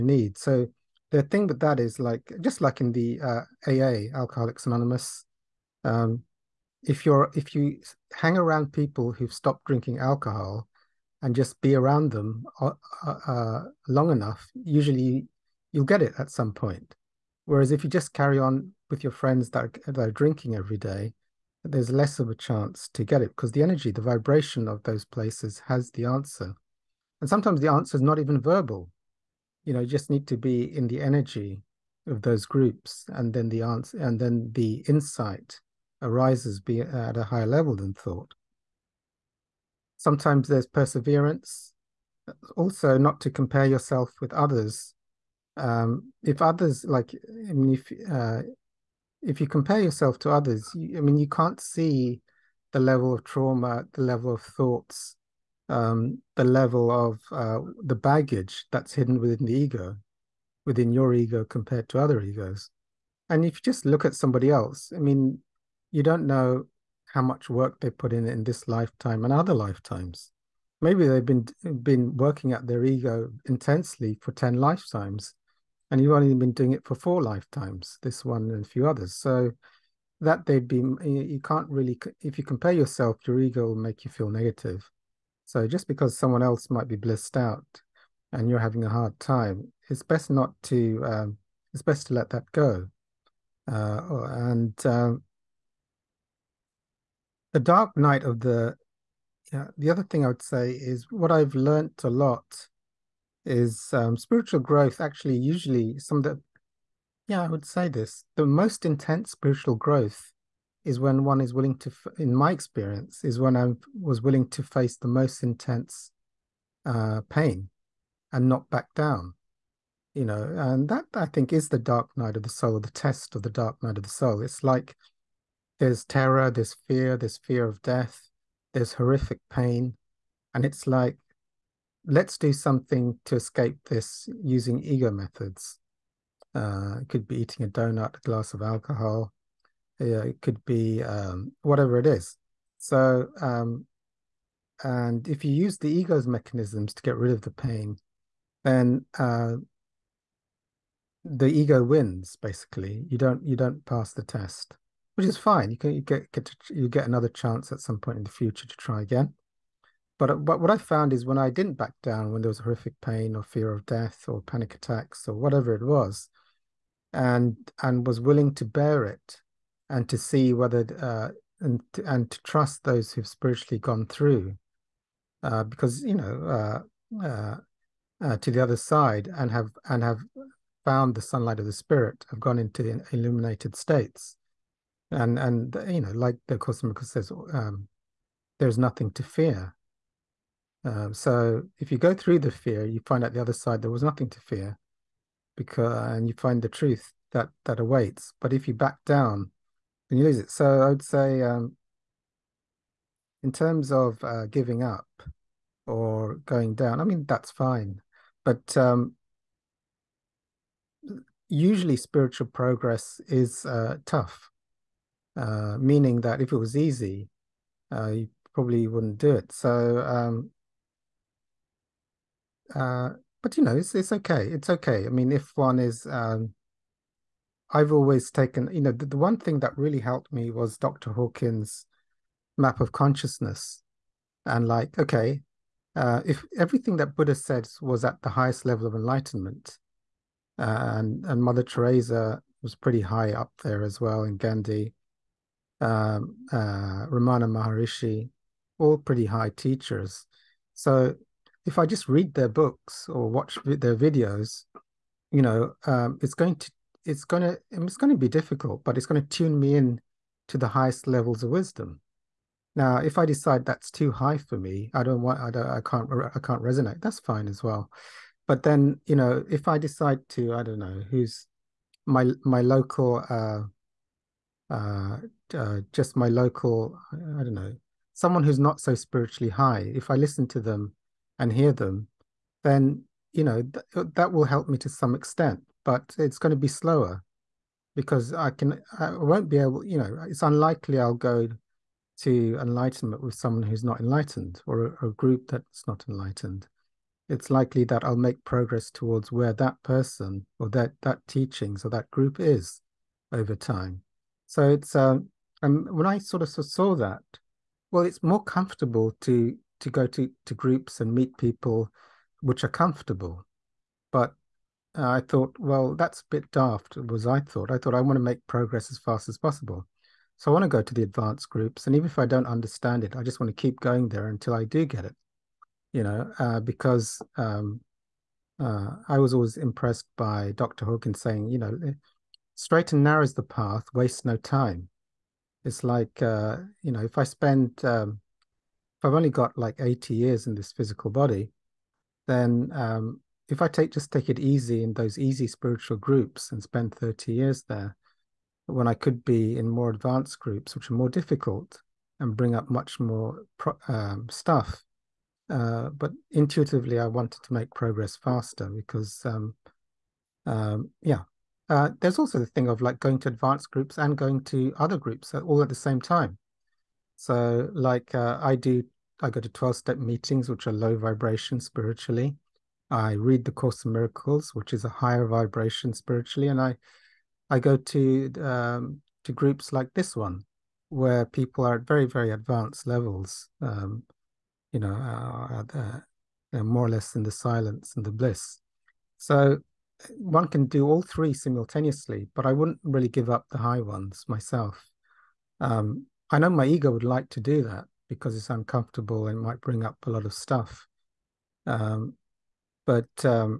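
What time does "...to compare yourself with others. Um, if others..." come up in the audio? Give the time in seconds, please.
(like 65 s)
43 s.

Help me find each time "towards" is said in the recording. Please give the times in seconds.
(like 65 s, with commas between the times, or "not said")
298 s.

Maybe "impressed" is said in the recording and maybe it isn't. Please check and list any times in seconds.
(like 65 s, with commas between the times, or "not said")
329 s.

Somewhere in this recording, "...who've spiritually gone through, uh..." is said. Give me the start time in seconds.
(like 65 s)
173 s.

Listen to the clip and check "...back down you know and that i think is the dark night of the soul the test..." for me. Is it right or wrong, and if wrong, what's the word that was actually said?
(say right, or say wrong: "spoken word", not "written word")
right.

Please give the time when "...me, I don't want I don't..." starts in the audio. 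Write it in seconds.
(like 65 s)
264 s.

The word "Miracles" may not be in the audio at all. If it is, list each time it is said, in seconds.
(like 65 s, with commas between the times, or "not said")
186 s, 373 s.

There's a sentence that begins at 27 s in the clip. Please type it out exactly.
And sometimes the answer is not even verbal.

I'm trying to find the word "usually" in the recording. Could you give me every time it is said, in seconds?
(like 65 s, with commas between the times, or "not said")
14 s, 105 s, 211 s.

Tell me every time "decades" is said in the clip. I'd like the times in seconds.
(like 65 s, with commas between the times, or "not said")
not said.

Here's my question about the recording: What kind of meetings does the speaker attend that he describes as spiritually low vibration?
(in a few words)
12 step meetings.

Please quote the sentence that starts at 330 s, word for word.
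Hawkins saying, you know, eh, straight and narrow is the path, waste no time.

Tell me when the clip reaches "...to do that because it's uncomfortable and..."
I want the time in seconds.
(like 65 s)
397 s.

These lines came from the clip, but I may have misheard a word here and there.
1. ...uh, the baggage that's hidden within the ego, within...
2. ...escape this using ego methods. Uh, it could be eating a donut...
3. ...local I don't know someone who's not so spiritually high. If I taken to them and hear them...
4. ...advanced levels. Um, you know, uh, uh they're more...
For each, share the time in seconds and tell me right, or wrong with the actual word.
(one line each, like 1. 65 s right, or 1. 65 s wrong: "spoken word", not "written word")
1. 57 s right
2. 133 s right
3. 276 s wrong: "listen", not "taken"
4. 382 s right.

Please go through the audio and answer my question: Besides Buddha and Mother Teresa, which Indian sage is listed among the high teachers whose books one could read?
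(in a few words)
Ramana Maharishi.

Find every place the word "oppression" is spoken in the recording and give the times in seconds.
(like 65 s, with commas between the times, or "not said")
not said.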